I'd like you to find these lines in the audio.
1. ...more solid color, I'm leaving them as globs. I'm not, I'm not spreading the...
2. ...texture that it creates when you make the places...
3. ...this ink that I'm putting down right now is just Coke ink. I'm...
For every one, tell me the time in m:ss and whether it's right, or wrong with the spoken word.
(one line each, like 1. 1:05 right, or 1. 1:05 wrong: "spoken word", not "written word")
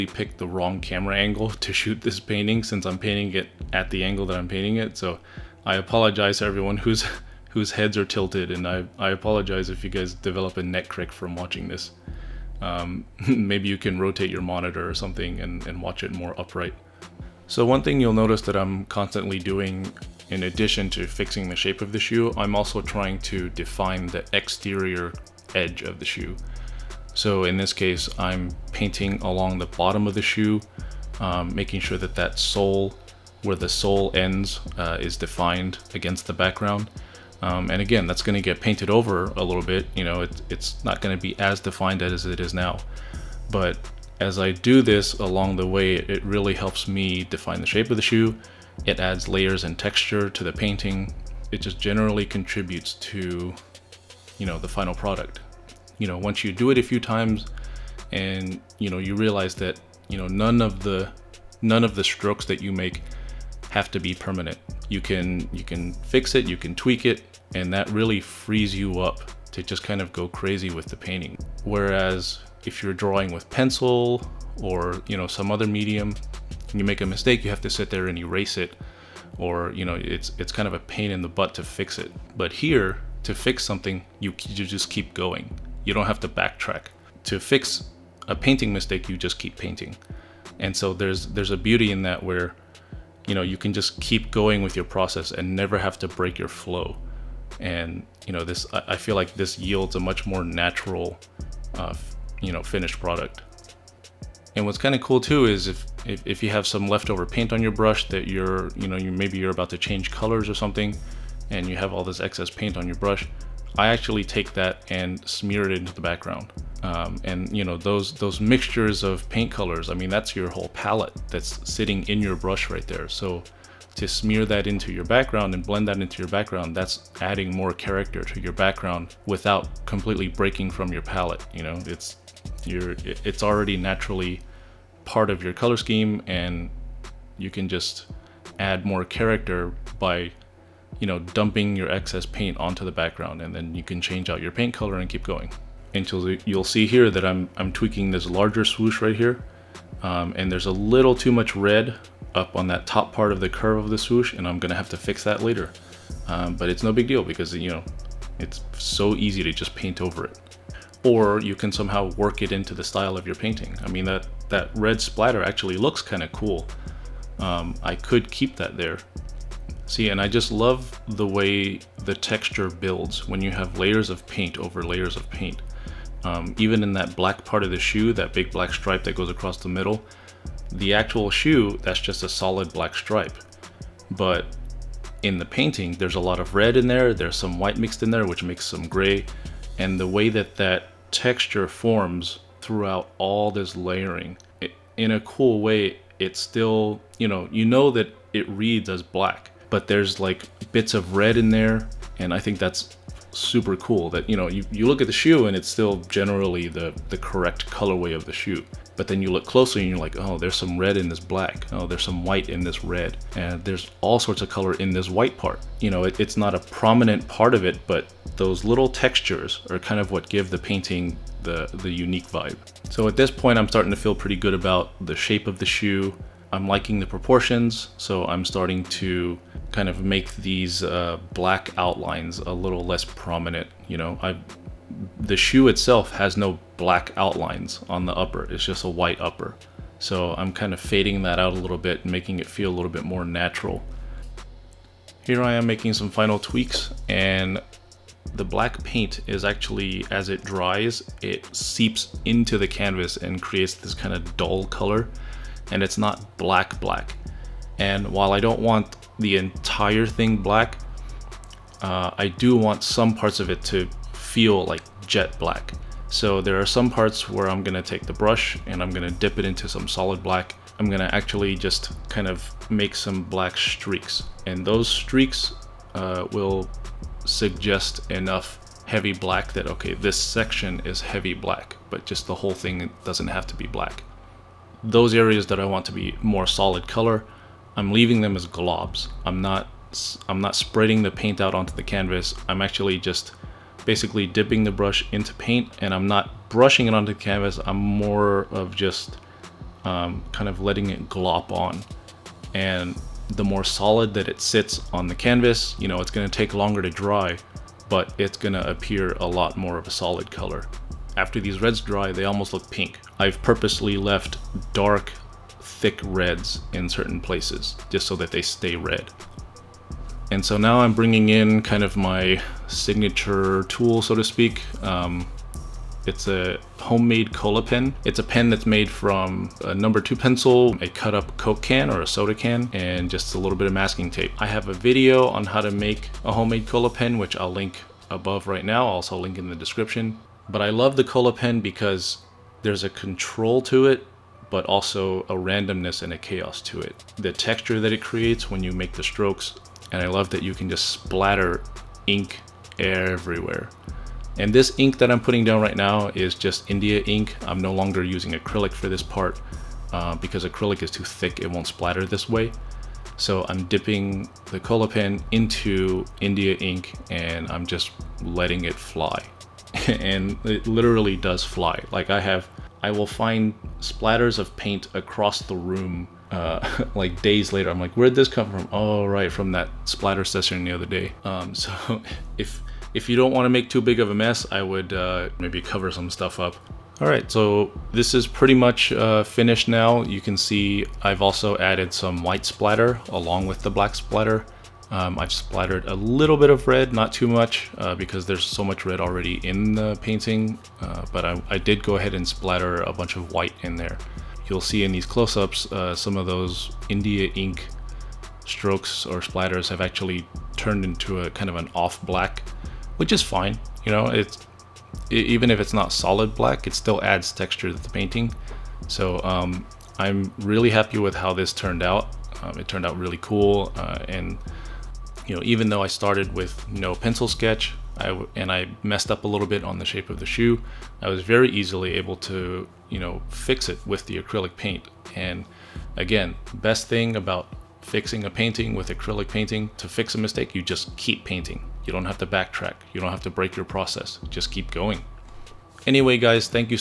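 1. 4:46 right
2. 5:47 wrong: "strokes", not "places"
3. 5:54 wrong: "India", not "Coke".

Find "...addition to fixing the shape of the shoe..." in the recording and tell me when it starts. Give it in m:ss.
0:20.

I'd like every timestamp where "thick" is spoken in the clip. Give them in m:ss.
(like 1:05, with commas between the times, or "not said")
5:15, 6:01.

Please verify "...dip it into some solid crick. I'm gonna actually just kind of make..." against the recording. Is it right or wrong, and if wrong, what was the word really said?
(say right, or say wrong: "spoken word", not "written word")
wrong: "black", not "crick".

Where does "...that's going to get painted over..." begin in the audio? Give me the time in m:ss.
0:38.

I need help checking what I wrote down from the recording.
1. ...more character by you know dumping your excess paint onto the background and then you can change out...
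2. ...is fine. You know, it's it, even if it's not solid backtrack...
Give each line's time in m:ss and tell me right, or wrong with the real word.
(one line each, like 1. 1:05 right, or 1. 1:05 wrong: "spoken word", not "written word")
1. 2:18 right
2. 6:53 wrong: "black", not "backtrack".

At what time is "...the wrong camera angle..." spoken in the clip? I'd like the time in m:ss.
0:00.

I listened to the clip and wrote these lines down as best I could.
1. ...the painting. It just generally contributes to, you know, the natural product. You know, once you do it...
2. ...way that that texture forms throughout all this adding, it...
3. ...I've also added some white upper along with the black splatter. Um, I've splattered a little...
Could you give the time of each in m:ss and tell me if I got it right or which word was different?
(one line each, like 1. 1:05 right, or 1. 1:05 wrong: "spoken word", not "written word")
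1. 0:50 wrong: "final", not "natural"
2. 3:10 wrong: "layering", not "adding"
3. 6:31 wrong: "splatter", not "upper".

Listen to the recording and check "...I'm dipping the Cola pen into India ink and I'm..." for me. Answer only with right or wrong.
right.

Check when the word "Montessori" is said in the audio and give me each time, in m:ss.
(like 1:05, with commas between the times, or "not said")
not said.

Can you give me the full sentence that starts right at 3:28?
But then you look closely and you're like, oh, there's some red in this black.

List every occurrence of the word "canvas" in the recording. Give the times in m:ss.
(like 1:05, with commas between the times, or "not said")
4:12, 4:51, 4:57, 5:05.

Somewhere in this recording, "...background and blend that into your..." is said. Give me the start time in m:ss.
2:05.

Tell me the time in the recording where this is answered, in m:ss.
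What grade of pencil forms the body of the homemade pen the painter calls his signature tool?
5:29.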